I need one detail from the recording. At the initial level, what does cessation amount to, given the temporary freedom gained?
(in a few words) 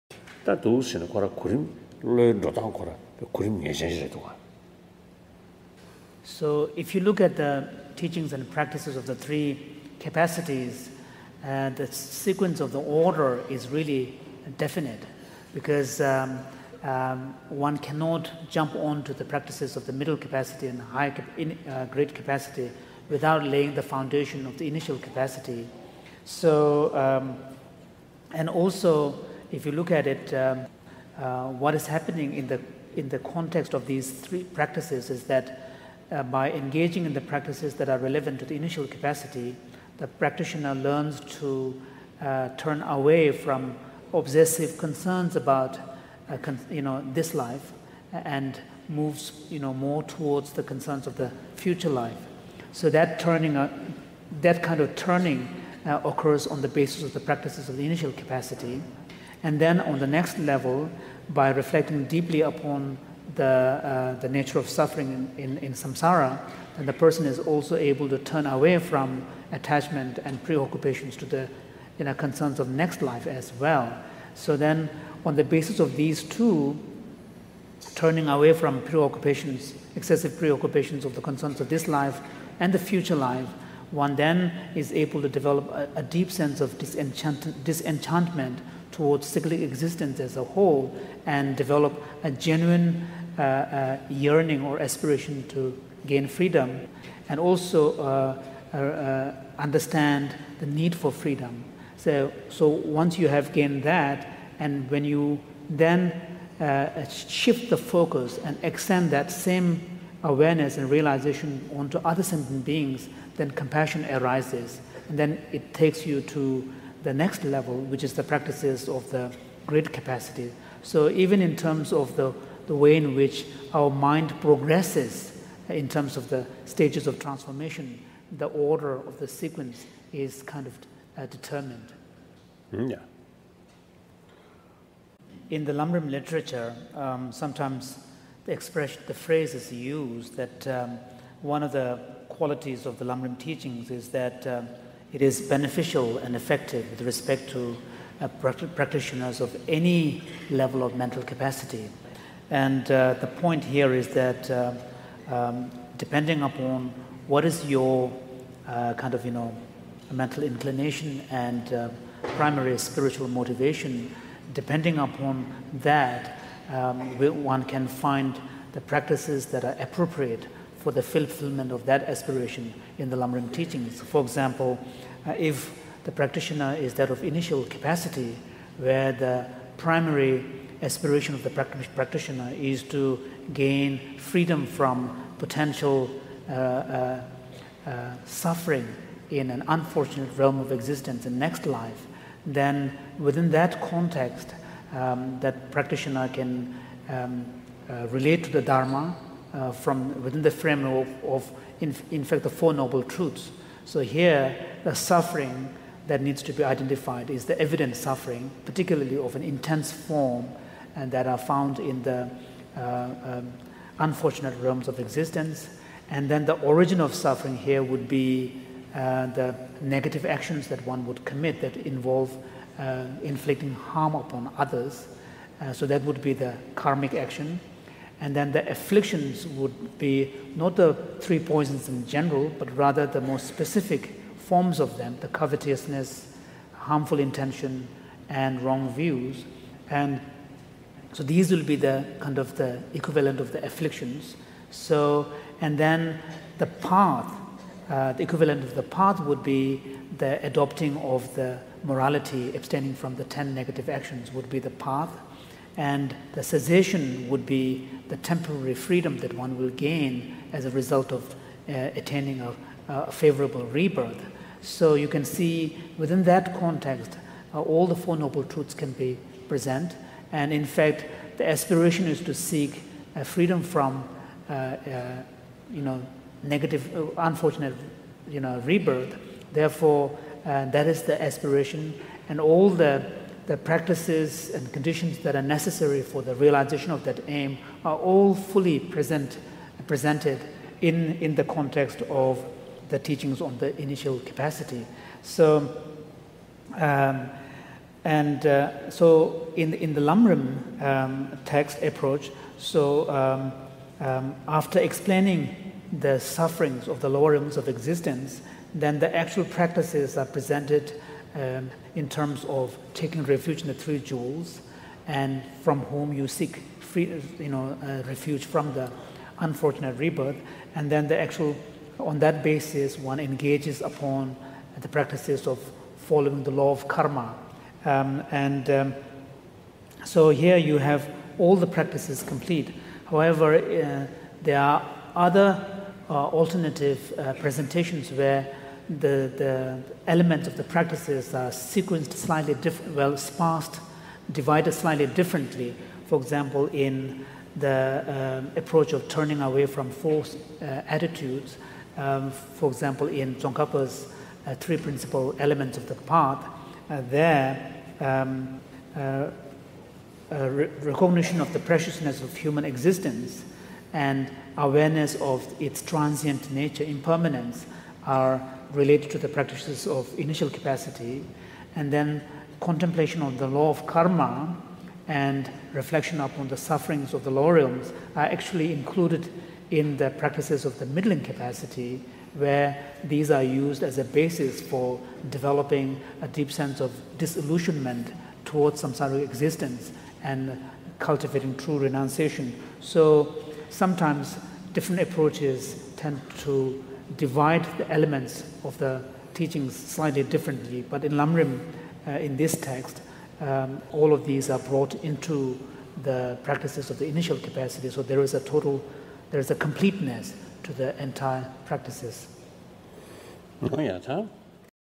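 A favorable rebirth.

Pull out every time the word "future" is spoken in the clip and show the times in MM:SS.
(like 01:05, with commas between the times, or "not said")
00:51, 01:22.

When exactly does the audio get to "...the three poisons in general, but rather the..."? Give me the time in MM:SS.
03:50.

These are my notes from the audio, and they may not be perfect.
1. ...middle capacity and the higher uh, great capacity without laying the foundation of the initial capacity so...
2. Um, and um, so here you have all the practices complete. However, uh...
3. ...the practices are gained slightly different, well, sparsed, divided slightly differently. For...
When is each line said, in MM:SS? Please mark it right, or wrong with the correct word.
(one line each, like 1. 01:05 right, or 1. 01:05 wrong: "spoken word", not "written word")
1. 00:19 right
2. 05:27 right
3. 05:40 wrong: "sequenced", not "gained".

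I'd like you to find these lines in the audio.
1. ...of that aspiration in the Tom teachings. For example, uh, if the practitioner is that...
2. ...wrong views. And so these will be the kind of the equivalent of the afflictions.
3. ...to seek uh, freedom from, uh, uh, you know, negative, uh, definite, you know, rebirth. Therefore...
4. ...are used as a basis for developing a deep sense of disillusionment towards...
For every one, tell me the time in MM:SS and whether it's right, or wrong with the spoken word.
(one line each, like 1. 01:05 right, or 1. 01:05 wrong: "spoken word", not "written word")
1. 02:51 wrong: "Lamrim", not "Tom"
2. 03:58 right
3. 04:32 wrong: "unfortunate", not "definite"
4. 06:23 right.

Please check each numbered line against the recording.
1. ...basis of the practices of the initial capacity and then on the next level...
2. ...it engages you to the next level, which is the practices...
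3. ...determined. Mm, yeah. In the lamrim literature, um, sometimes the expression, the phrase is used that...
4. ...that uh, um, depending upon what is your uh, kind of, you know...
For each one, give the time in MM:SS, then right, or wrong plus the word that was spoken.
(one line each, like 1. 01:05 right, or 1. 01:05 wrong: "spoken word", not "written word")
1. 00:56 right
2. 01:55 wrong: "takes", not "engages"
3. 02:11 right
4. 02:34 right.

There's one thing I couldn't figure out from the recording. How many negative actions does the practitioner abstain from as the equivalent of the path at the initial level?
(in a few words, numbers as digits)
10.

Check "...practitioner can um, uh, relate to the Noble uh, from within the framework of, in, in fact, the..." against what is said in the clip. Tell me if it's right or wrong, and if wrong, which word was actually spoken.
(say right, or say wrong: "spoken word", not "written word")
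wrong: "Dharma", not "Noble".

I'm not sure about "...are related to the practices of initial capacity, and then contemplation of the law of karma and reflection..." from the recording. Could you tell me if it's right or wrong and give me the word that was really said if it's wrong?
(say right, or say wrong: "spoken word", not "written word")
right.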